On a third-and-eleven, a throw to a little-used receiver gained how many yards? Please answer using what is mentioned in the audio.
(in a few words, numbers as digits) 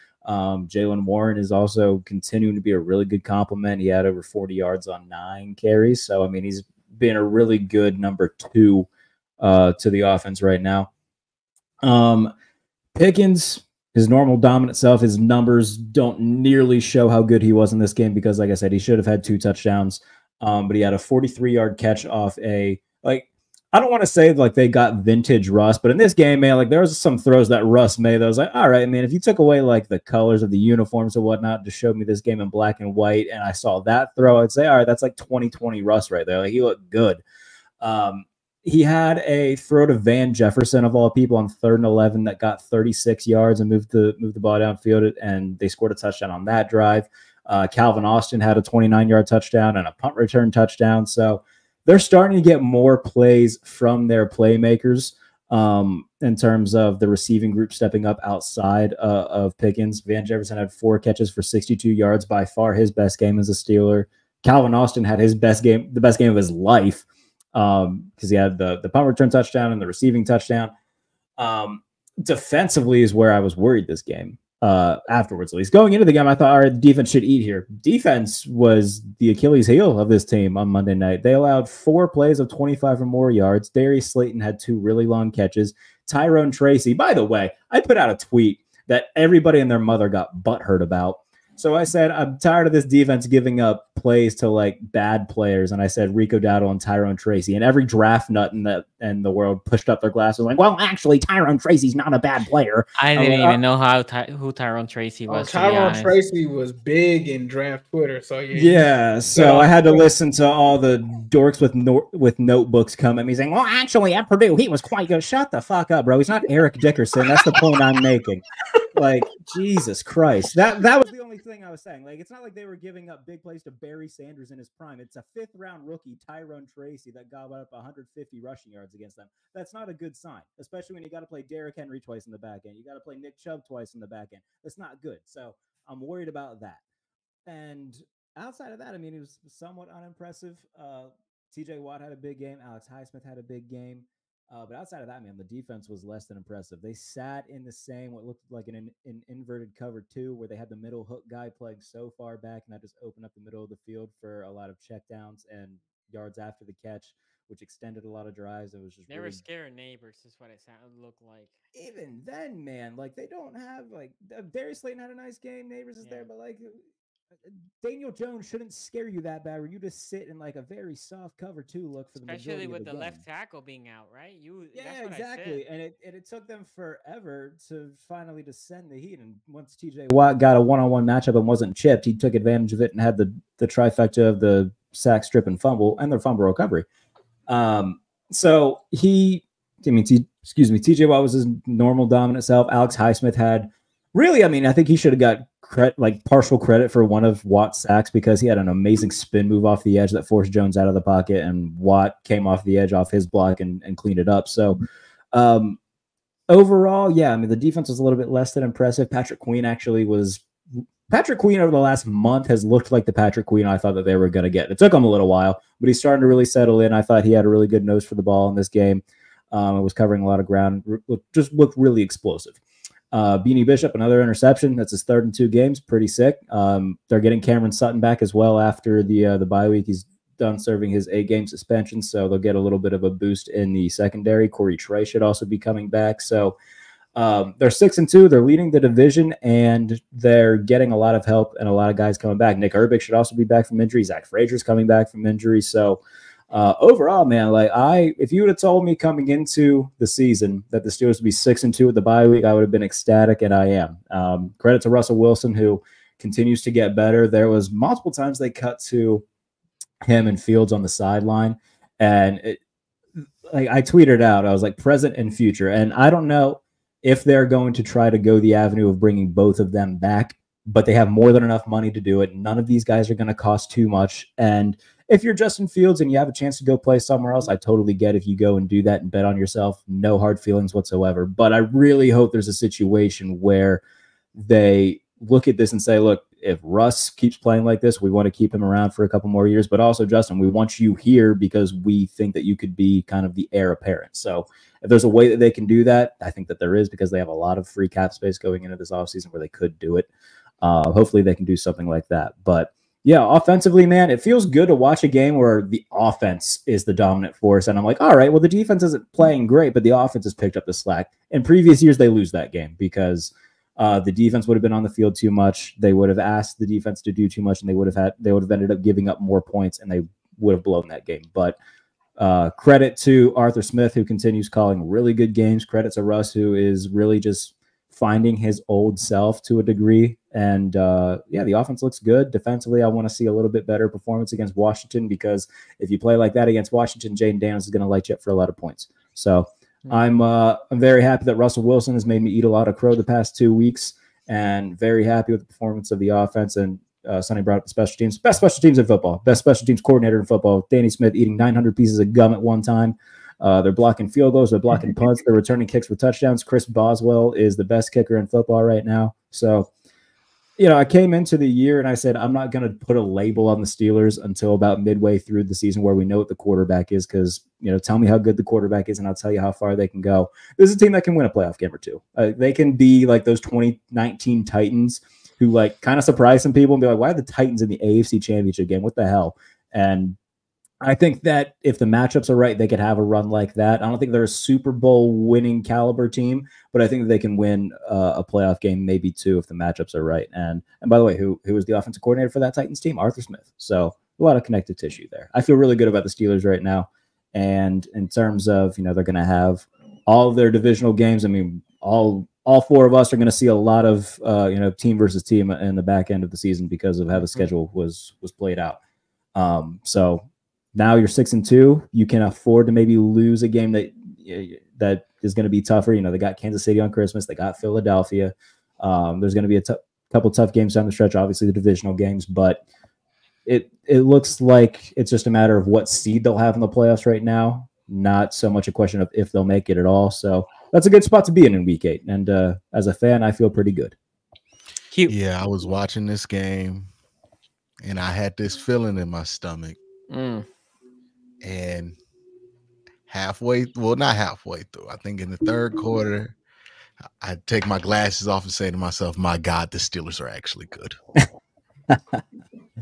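36.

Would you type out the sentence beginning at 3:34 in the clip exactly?
It took him a little while, but he's starting to really settle in.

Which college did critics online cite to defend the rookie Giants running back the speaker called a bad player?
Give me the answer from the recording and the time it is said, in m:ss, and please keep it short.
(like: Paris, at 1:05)
Purdue, at 1:54.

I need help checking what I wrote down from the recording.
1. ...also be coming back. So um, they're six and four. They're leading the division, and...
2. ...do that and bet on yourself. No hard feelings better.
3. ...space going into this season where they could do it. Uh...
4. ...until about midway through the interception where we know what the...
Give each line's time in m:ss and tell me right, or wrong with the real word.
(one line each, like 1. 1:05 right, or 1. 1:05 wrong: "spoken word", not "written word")
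1. 3:55 wrong: "two", not "four"
2. 4:38 wrong: "whatsoever", not "better"
3. 4:58 wrong: "offseason", not "season"
4. 6:04 wrong: "season", not "interception".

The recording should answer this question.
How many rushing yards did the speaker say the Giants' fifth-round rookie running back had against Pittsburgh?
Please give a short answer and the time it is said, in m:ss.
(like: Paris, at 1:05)
150, at 2:07.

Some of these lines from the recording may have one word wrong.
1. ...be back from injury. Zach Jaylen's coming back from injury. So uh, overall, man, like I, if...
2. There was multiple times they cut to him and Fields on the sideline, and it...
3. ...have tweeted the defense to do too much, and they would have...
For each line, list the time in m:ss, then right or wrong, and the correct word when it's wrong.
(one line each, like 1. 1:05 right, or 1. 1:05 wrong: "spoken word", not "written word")
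1. 4:03 wrong: "Frazier", not "Jaylen"
2. 4:17 right
3. 5:16 wrong: "asked", not "tweeted".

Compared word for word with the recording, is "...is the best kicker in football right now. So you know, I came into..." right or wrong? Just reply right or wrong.
right.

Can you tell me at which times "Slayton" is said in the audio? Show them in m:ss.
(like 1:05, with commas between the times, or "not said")
1:24, 2:44.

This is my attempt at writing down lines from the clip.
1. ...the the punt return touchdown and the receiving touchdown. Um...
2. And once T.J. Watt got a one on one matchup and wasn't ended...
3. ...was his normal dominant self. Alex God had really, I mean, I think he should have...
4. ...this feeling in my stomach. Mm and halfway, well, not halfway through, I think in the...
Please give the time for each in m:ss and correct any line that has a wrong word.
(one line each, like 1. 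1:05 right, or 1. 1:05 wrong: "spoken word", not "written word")
1. 1:08 right
2. 2:59 wrong: "chipped", not "ended"
3. 3:11 wrong: "Highsmith", not "God"
4. 7:18 right.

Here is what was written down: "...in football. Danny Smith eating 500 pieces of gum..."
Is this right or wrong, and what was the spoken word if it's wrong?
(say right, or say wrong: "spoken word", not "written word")
wrong: "900", not "500".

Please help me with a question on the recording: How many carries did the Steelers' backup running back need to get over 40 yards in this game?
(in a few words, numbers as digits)
9.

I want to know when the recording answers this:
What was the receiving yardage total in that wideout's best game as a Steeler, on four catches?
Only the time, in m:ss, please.
1:01.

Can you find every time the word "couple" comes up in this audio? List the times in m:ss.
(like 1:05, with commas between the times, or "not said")
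4:49, 7:00.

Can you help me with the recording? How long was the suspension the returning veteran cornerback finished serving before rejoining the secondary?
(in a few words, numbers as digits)
8 games.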